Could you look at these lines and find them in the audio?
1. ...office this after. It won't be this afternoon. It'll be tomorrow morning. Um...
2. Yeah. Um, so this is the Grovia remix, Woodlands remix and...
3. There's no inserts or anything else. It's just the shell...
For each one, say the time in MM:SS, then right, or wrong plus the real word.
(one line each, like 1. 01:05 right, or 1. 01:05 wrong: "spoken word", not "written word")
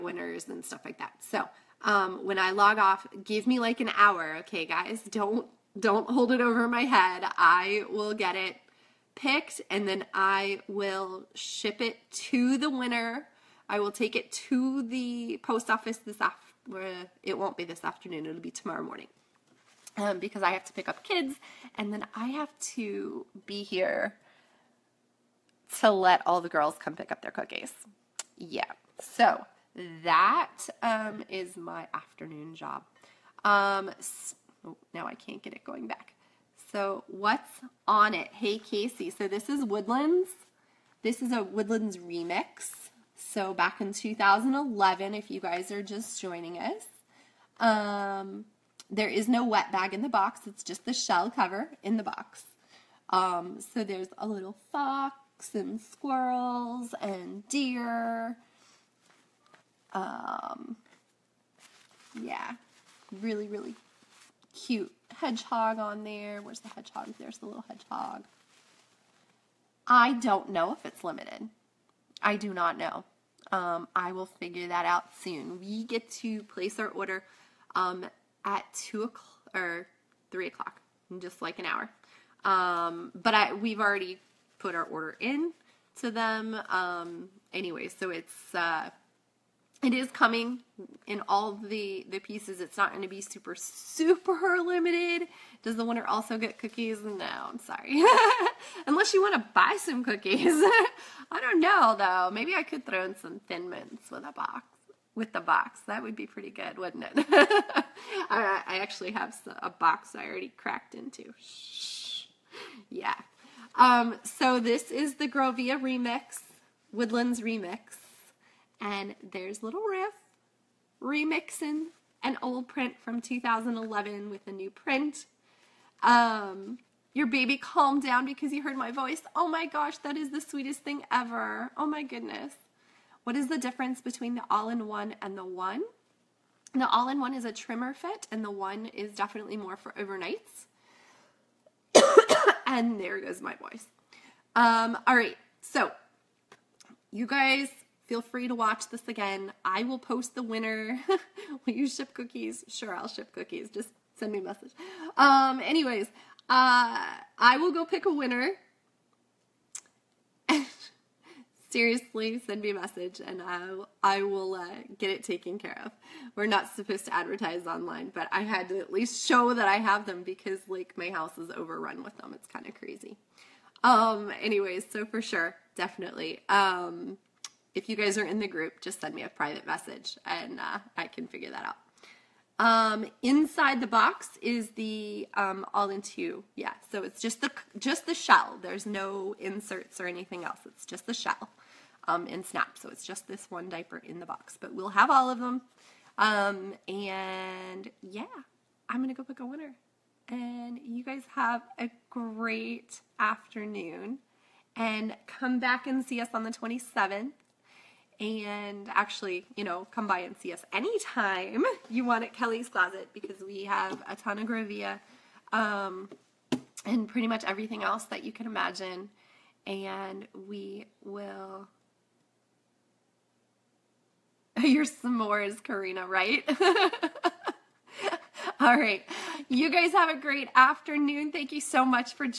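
1. 00:15 right
2. 01:52 right
3. 03:08 right.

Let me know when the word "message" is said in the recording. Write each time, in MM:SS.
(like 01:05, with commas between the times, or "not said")
02:34, 02:42, 02:59.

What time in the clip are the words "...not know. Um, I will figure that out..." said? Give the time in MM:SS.
01:12.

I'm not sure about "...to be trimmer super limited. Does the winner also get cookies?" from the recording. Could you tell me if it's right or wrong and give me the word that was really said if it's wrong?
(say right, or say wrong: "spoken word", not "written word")
wrong: "super", not "trimmer".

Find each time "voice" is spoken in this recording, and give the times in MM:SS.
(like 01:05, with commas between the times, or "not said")
02:08, 02:23.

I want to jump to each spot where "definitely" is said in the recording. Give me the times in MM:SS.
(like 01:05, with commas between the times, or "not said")
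02:19, 02:55.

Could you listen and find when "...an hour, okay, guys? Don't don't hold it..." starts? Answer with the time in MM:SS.
00:03.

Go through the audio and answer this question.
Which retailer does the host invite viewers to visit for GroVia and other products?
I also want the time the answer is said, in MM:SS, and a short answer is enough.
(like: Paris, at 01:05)
Kelly's Closet, at 03:32.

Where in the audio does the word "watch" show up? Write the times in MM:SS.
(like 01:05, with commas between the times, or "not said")
02:28.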